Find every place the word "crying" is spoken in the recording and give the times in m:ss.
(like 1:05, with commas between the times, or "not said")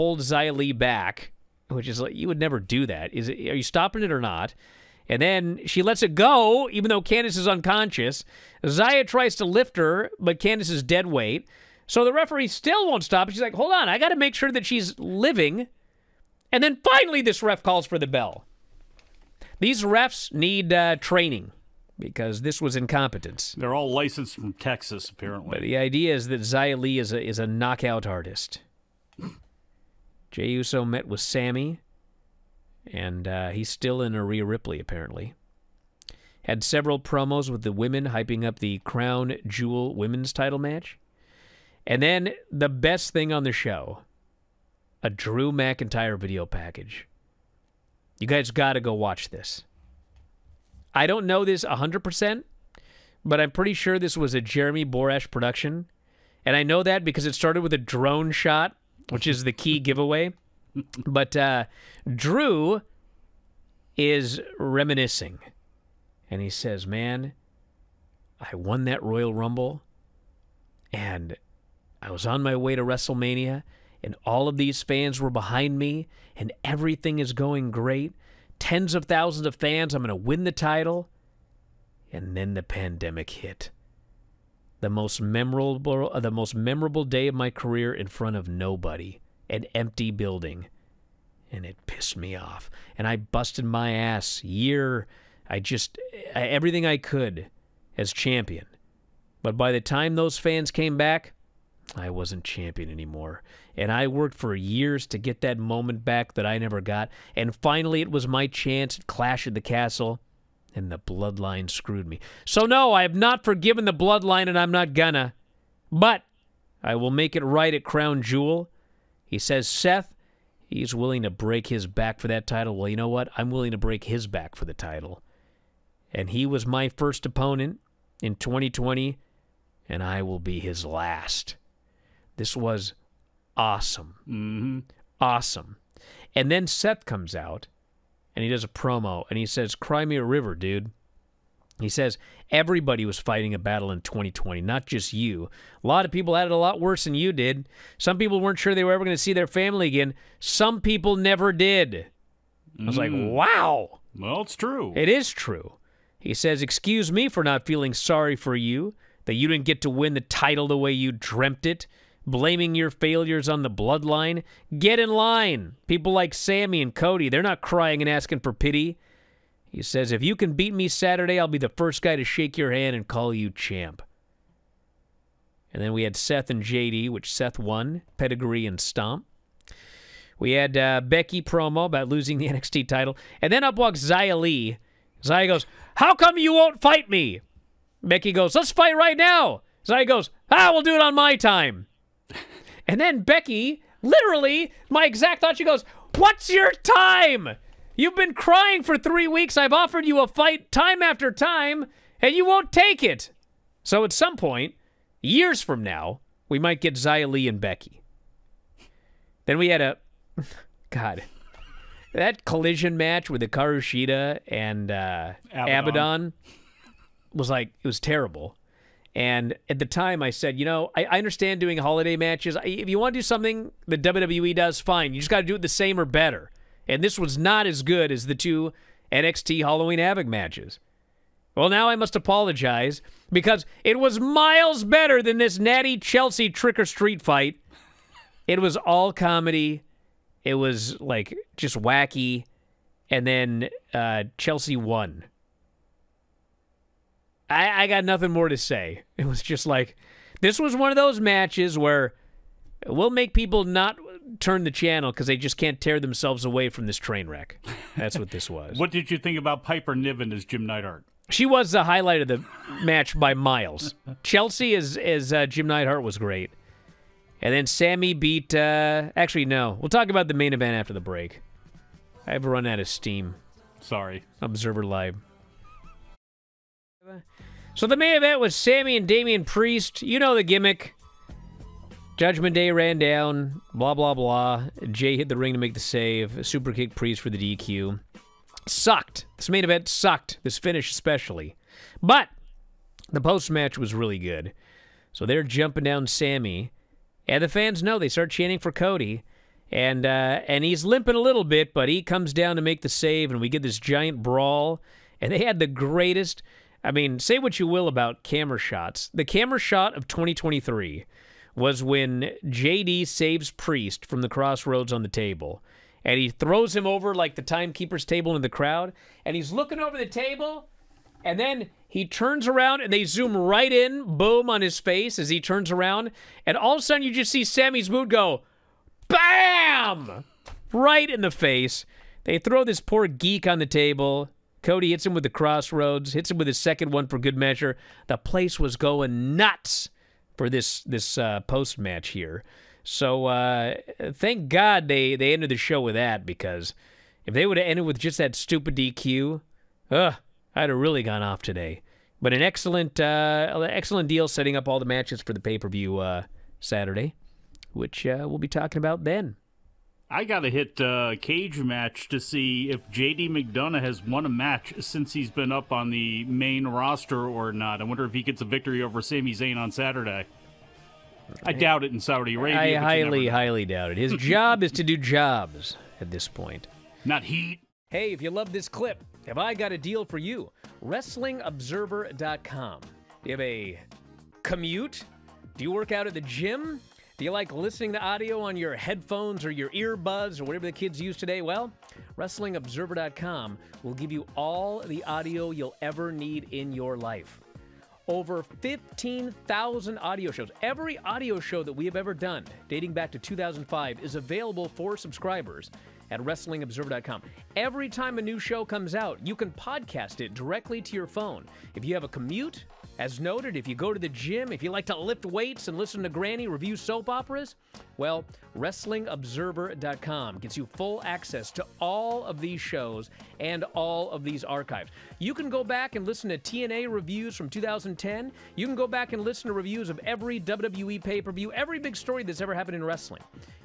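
2:47, 3:18.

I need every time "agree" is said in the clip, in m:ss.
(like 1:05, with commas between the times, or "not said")
not said.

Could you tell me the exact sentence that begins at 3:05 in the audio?
Xia goes, how come you won't fight me?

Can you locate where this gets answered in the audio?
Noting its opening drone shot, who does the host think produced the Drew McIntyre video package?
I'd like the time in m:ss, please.
0:54.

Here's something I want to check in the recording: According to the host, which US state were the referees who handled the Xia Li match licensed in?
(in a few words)
Texas.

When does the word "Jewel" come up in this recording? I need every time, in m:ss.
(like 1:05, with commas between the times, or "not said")
0:39, 1:58.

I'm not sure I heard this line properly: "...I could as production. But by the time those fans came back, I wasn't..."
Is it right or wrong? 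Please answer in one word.
wrong.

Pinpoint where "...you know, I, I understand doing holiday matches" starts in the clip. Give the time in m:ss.
3:40.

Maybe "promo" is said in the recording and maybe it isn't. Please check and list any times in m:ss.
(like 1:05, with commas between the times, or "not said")
0:36, 2:18, 3:01.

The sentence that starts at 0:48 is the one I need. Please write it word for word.
You guys got to go watch this.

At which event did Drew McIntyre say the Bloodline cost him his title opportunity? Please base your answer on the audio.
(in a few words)
Clash of the Castle.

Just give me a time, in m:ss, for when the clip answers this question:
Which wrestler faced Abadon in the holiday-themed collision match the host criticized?
3:33.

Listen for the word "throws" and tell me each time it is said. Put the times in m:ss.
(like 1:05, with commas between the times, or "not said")
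5:16, 5:32.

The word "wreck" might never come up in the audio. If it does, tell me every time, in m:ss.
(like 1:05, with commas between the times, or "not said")
4:17.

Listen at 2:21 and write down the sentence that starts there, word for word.
He says, Everybody was fighting a battle in 2020, not just you.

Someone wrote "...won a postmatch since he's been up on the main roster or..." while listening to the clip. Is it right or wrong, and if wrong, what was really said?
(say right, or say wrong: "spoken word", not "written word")
wrong: "match", not "postmatch".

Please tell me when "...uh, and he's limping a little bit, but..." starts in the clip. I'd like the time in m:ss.
5:00.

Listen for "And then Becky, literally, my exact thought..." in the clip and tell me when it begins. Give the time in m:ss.
3:12.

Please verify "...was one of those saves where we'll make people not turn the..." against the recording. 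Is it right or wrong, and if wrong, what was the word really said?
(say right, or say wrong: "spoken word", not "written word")
wrong: "matches", not "saves".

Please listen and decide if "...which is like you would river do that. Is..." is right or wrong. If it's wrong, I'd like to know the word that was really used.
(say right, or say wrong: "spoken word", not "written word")
wrong: "never", not "river".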